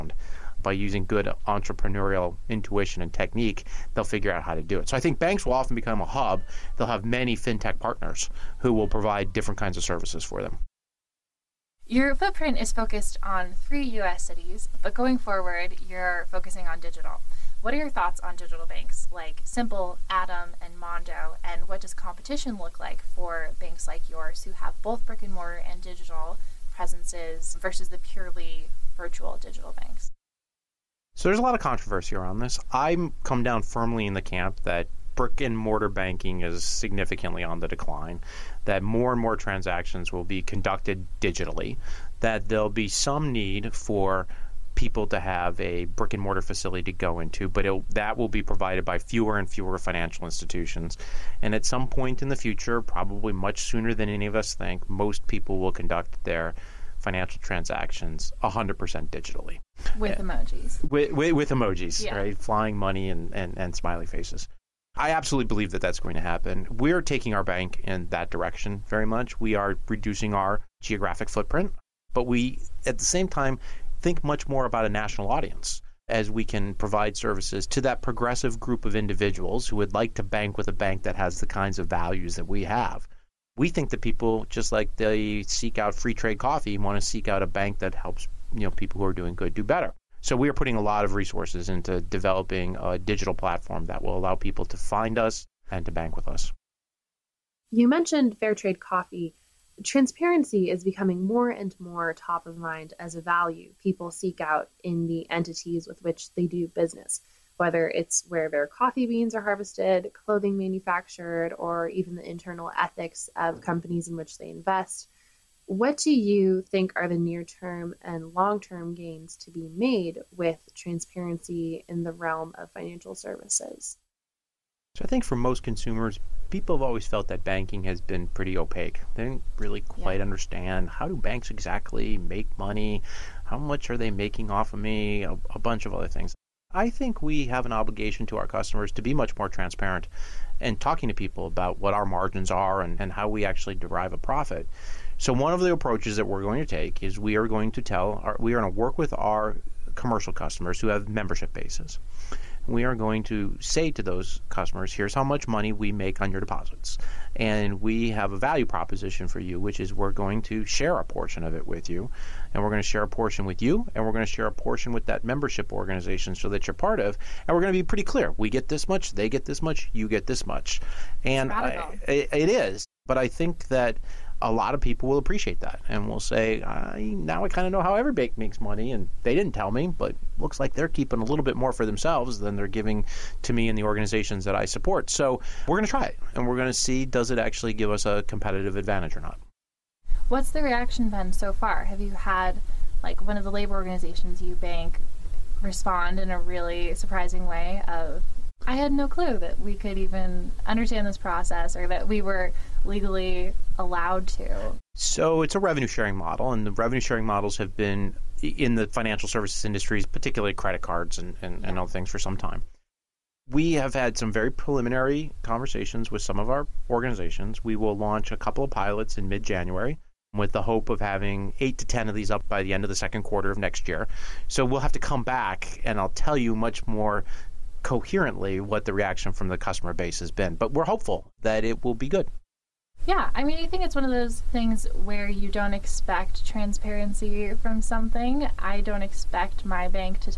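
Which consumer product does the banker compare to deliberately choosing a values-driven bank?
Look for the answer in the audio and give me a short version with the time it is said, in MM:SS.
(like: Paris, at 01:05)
Free trade coffee, at 01:25.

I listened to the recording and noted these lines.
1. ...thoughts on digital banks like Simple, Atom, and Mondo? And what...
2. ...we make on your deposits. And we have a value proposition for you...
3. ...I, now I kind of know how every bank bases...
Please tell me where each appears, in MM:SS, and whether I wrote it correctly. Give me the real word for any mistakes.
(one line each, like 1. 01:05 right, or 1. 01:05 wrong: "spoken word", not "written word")
1. 00:17 right
2. 02:35 right
3. 02:56 wrong: "makes", not "bases".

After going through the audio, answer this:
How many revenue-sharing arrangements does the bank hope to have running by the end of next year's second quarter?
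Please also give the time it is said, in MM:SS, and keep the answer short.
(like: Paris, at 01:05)
8 to 10, at 03:41.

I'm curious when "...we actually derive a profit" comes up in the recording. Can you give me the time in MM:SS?
02:23.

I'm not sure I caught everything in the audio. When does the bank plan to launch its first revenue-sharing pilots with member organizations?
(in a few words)
Mid January.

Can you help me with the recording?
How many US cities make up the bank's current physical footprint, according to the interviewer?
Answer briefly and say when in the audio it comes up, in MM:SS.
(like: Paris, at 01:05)
3, at 00:13.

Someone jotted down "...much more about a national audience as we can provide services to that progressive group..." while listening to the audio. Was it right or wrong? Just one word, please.
right.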